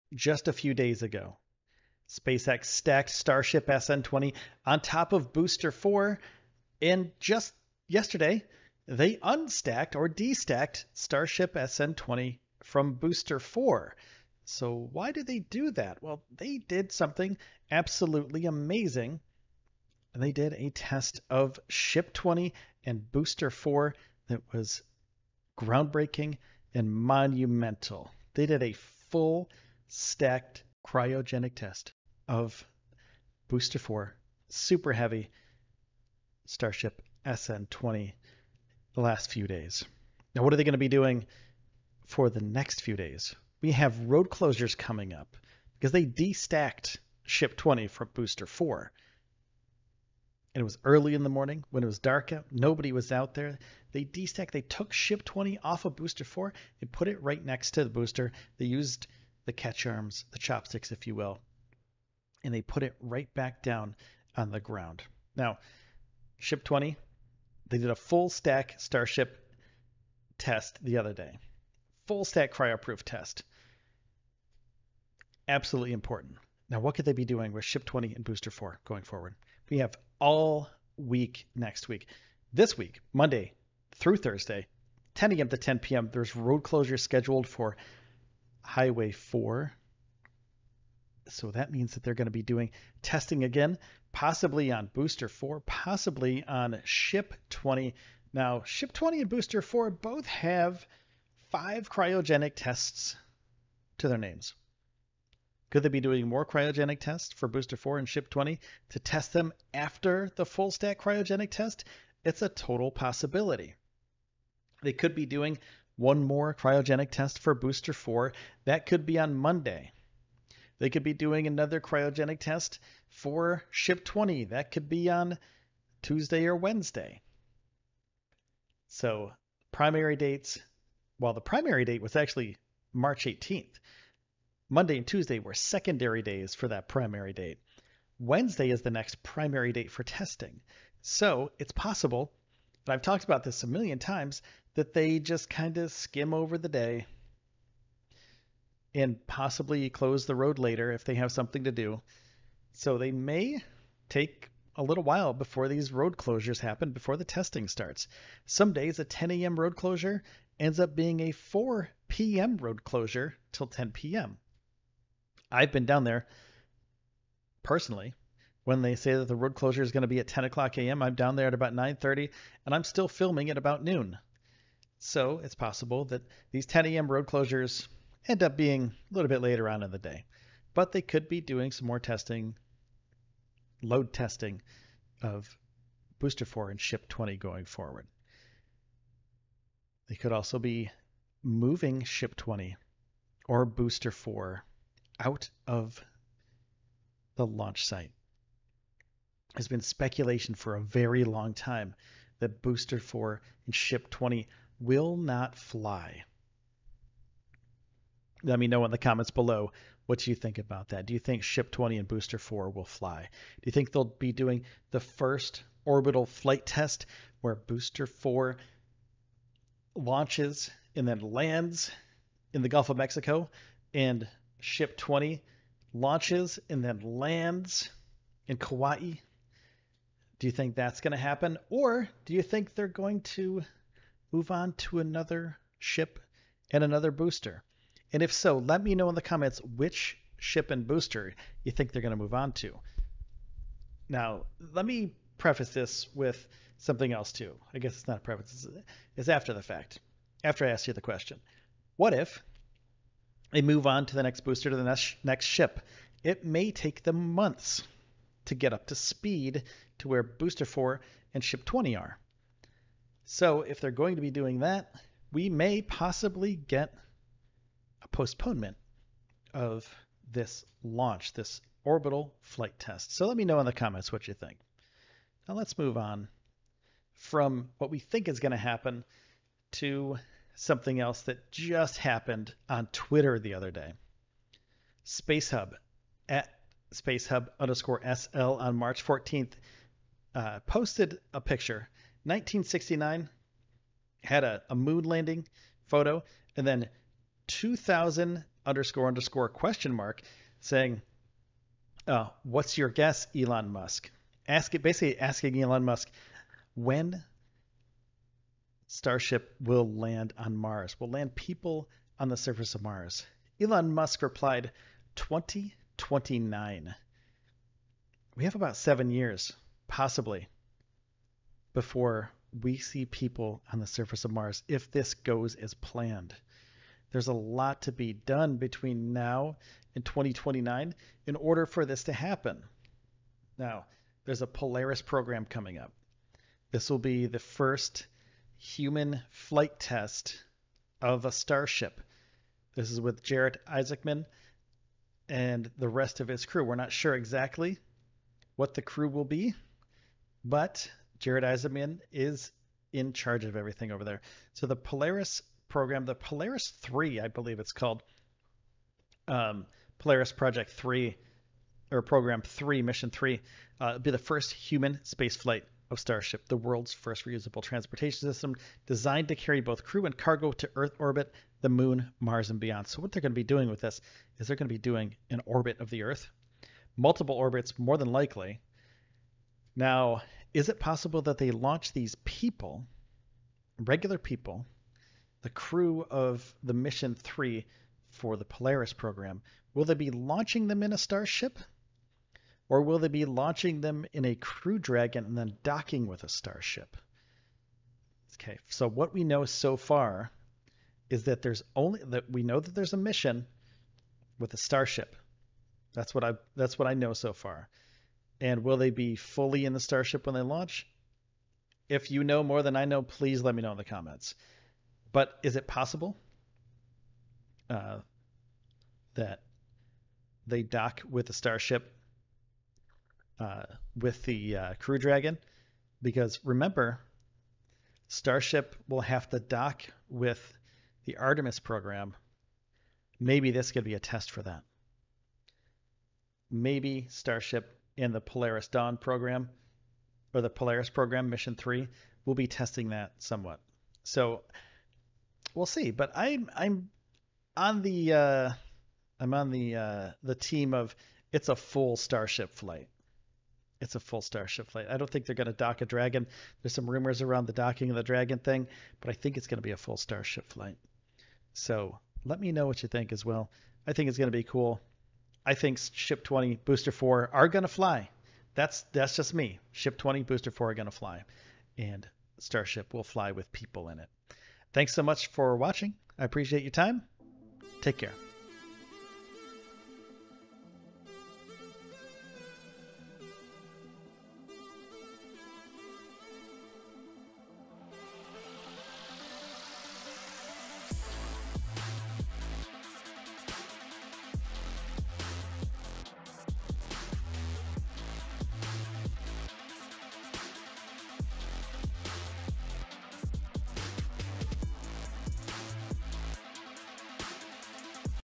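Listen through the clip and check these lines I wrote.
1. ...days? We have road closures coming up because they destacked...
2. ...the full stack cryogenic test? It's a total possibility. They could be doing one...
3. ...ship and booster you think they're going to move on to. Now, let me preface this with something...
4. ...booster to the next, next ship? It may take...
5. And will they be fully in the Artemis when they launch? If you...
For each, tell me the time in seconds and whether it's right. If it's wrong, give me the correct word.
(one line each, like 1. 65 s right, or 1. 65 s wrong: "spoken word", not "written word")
1. 42 s right
2. 110 s right
3. 240 s right
4. 254 s right
5. 408 s wrong: "Starship", not "Artemis".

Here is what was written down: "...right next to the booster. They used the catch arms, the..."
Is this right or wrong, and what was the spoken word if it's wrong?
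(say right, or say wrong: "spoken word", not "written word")
right.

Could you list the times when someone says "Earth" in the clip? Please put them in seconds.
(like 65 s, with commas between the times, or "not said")
370 s, 376 s.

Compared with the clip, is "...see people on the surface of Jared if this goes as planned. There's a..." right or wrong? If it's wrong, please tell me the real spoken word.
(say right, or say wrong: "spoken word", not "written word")
wrong: "Mars", not "Jared".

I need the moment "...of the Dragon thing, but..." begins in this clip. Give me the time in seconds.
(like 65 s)
457 s.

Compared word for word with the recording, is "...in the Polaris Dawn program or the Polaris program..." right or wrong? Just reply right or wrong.
right.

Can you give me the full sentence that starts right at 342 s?
This is with Jared Isaacman and the rest of his crew.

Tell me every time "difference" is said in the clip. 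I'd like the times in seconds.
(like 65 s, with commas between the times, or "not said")
not said.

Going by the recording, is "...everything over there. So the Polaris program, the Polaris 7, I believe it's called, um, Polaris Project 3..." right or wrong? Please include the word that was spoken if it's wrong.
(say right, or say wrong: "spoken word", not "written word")
wrong: "3", not "7".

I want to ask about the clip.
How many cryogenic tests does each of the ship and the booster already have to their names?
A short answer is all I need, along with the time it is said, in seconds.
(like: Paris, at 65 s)
5, at 101 s.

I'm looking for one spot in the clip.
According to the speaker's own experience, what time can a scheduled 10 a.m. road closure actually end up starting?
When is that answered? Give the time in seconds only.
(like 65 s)
161 s.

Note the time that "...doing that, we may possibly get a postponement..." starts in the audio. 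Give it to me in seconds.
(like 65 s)
264 s.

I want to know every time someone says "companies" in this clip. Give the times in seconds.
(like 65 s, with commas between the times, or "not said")
not said.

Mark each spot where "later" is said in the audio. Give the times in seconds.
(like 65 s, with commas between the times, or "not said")
150 s, 179 s.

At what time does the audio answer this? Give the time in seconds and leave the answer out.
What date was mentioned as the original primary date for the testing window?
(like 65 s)
132 s.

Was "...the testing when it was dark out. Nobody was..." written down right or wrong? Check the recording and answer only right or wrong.
wrong.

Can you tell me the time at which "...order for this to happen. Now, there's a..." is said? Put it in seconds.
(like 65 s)
331 s.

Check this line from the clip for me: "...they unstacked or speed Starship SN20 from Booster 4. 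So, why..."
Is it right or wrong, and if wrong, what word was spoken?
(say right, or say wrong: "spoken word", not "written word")
wrong: "destacked", not "speed".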